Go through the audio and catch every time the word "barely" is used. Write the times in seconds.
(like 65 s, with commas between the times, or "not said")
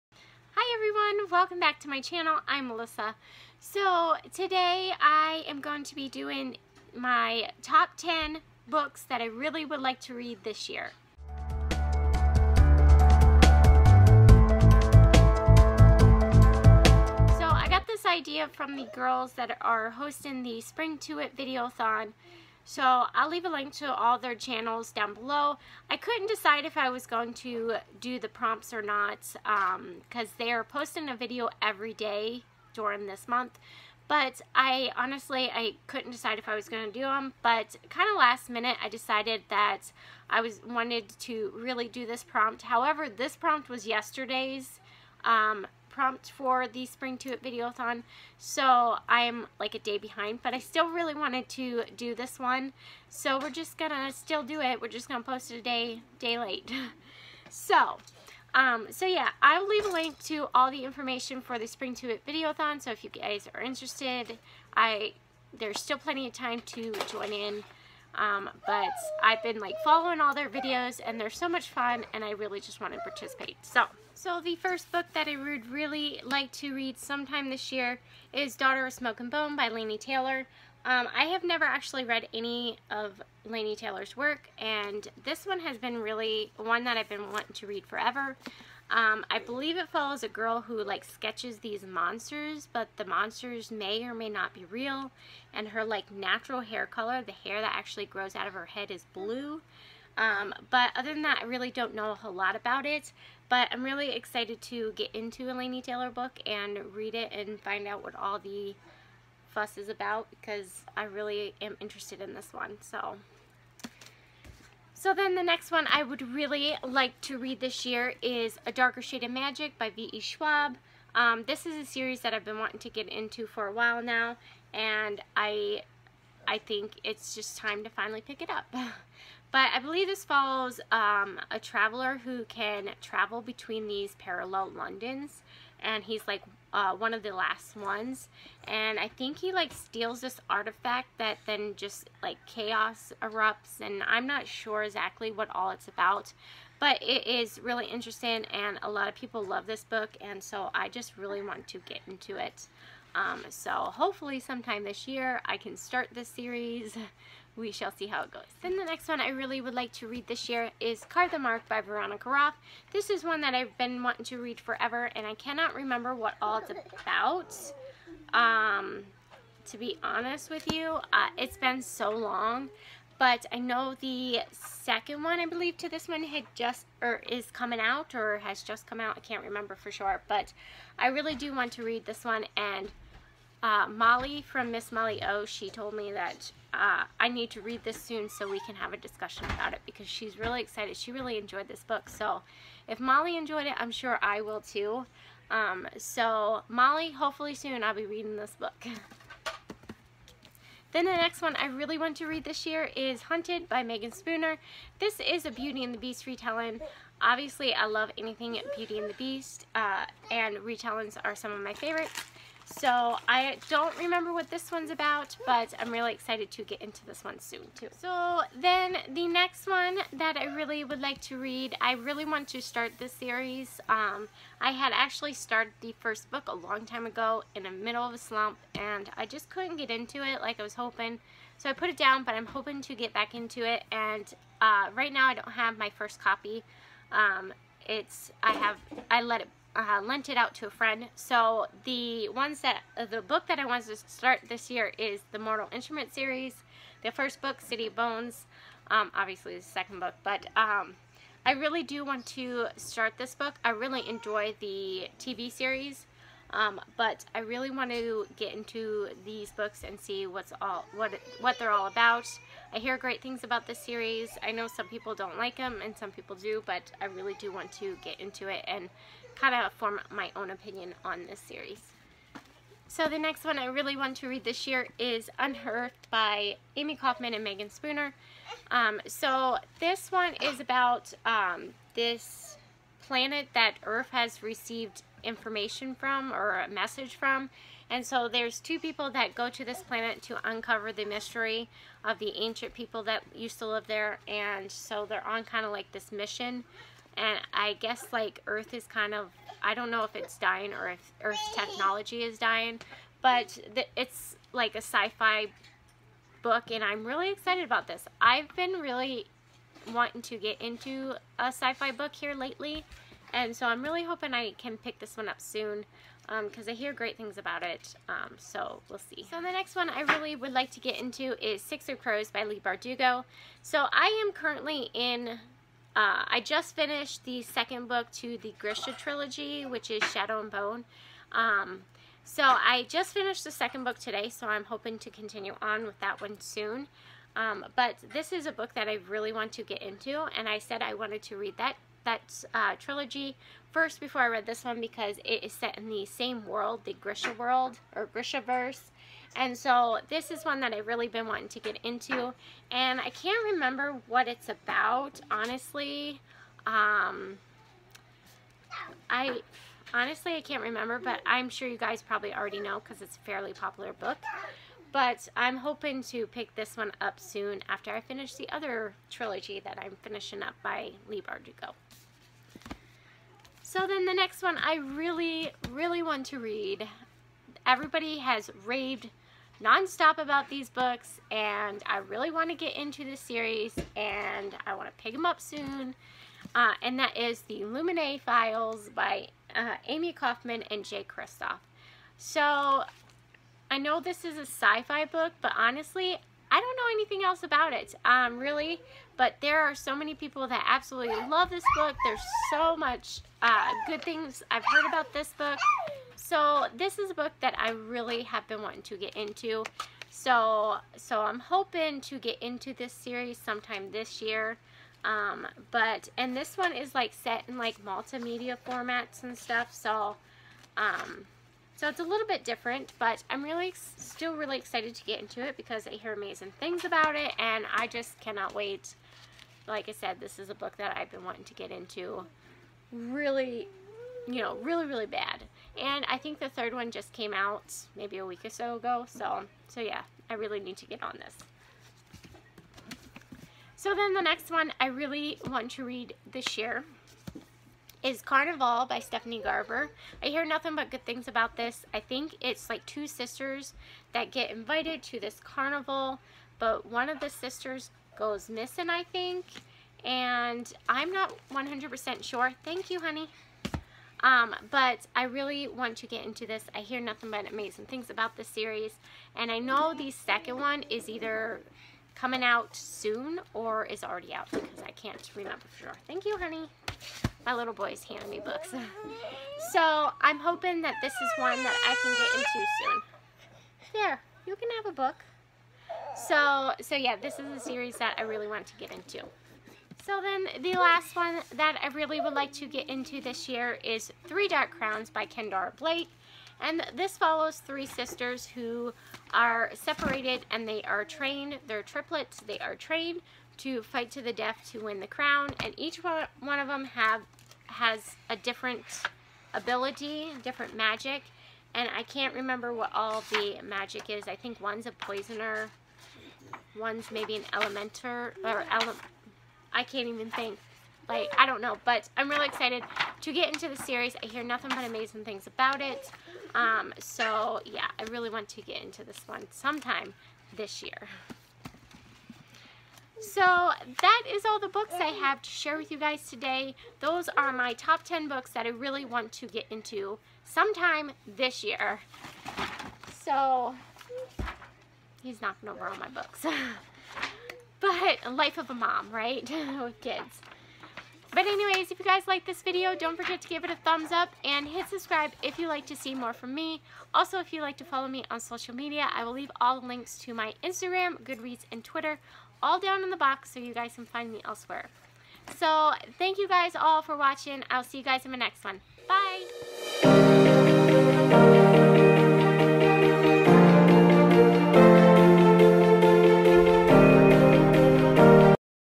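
not said.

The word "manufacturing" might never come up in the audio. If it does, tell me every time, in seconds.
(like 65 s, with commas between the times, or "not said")
not said.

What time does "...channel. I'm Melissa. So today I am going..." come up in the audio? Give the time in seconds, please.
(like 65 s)
2 s.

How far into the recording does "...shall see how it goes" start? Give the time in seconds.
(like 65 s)
157 s.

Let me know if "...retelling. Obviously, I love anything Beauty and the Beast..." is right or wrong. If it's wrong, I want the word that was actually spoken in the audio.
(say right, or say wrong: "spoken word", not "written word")
right.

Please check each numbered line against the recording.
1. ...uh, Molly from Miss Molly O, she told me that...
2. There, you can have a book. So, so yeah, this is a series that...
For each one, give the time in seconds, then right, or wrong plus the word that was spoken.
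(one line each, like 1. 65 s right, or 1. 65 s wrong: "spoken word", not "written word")
1. 183 s right
2. 483 s right.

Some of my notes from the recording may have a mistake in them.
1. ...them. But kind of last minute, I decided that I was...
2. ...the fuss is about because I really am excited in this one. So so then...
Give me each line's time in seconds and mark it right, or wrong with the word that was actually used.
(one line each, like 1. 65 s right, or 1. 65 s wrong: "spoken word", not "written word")
1. 37 s right
2. 108 s wrong: "interested", not "excited".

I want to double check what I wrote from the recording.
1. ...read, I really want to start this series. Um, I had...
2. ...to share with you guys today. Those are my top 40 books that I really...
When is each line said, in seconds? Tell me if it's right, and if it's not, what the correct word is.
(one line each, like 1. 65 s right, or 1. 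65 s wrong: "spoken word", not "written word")
1. 221 s right
2. 535 s wrong: "10", not "40".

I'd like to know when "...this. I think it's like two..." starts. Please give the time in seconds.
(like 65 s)
451 s.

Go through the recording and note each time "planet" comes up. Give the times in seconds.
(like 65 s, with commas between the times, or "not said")
283 s, 289 s.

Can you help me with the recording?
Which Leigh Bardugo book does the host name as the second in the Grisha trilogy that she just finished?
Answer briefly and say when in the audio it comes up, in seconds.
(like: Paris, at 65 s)
Shadow and Bone, at 330 s.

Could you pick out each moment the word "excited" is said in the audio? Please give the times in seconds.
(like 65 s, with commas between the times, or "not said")
104 s, 190 s, 216 s, 307 s, 424 s, 522 s.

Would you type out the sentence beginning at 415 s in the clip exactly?
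Um, but, and this one is like set in like multimedia formats and stuff.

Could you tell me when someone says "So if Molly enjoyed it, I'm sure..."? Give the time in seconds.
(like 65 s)
192 s.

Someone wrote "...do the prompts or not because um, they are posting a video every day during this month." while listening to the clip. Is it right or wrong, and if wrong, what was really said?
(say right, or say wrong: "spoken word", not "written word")
right.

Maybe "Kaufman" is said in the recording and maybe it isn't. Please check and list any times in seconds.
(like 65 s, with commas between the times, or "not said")
276 s, 390 s.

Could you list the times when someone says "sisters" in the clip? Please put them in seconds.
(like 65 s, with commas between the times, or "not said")
453 s, 457 s, 497 s.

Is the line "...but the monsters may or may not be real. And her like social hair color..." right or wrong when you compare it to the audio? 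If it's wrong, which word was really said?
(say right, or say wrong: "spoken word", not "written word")
wrong: "natural", not "social".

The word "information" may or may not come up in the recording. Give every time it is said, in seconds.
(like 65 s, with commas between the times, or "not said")
60 s, 285 s.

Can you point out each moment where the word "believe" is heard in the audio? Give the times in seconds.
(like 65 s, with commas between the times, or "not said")
89 s, 129 s, 175 s.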